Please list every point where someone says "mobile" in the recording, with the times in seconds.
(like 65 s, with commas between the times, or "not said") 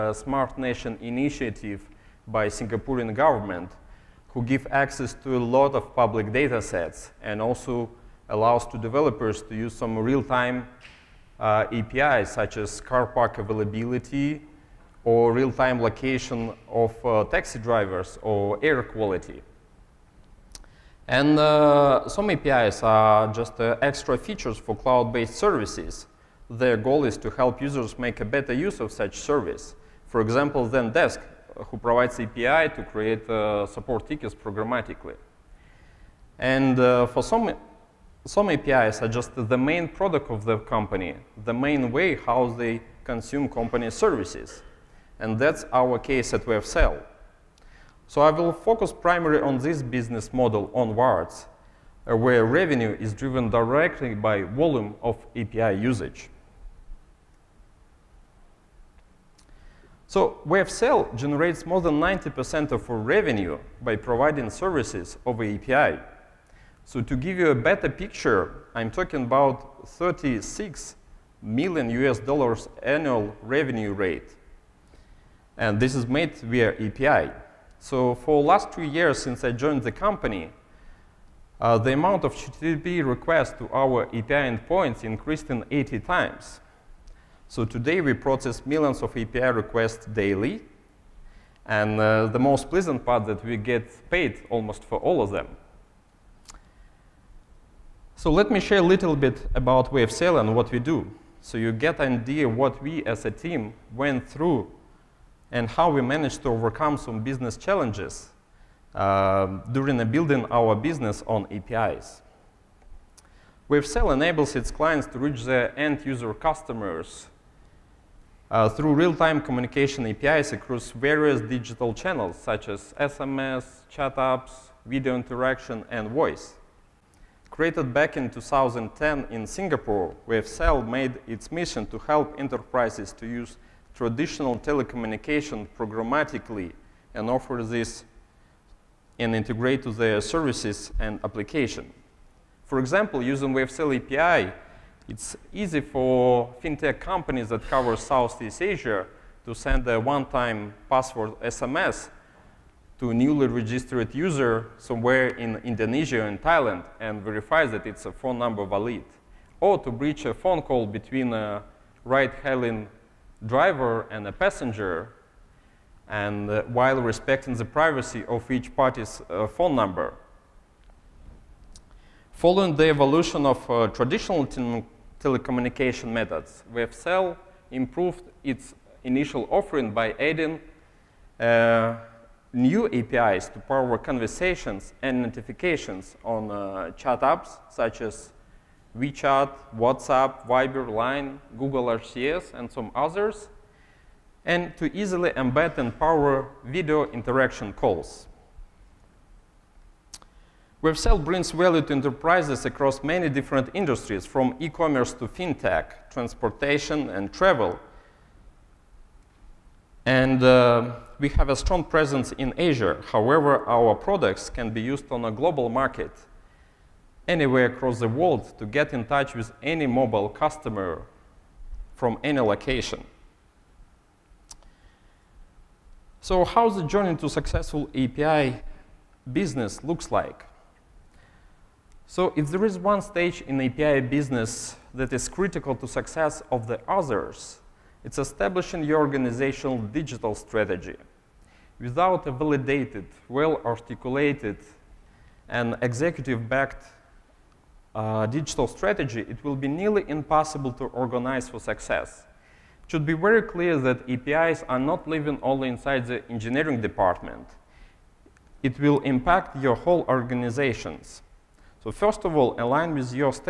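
219 s.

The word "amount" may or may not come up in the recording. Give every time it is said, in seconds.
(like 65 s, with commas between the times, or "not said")
81 s.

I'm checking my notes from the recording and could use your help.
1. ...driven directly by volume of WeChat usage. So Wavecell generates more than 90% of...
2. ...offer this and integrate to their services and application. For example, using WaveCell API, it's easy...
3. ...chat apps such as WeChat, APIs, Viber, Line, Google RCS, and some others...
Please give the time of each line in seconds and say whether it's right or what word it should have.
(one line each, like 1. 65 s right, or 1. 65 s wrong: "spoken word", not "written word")
1. 53 s wrong: "API", not "WeChat"
2. 137 s right
3. 186 s wrong: "WhatsApp", not "APIs".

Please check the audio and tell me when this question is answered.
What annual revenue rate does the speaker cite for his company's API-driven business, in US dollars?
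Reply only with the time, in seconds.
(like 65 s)
69 s.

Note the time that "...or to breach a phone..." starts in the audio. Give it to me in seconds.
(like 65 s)
159 s.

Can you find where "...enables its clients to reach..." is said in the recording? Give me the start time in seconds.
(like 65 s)
114 s.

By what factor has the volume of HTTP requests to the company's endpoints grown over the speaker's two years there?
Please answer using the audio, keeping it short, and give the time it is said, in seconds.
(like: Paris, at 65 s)
80 times, at 85 s.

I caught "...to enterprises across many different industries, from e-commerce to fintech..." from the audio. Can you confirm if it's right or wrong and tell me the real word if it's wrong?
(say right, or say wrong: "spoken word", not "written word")
right.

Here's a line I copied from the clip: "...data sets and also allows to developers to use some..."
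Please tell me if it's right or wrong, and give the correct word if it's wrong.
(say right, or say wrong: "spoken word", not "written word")
right.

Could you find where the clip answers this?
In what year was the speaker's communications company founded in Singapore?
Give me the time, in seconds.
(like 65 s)
128 s.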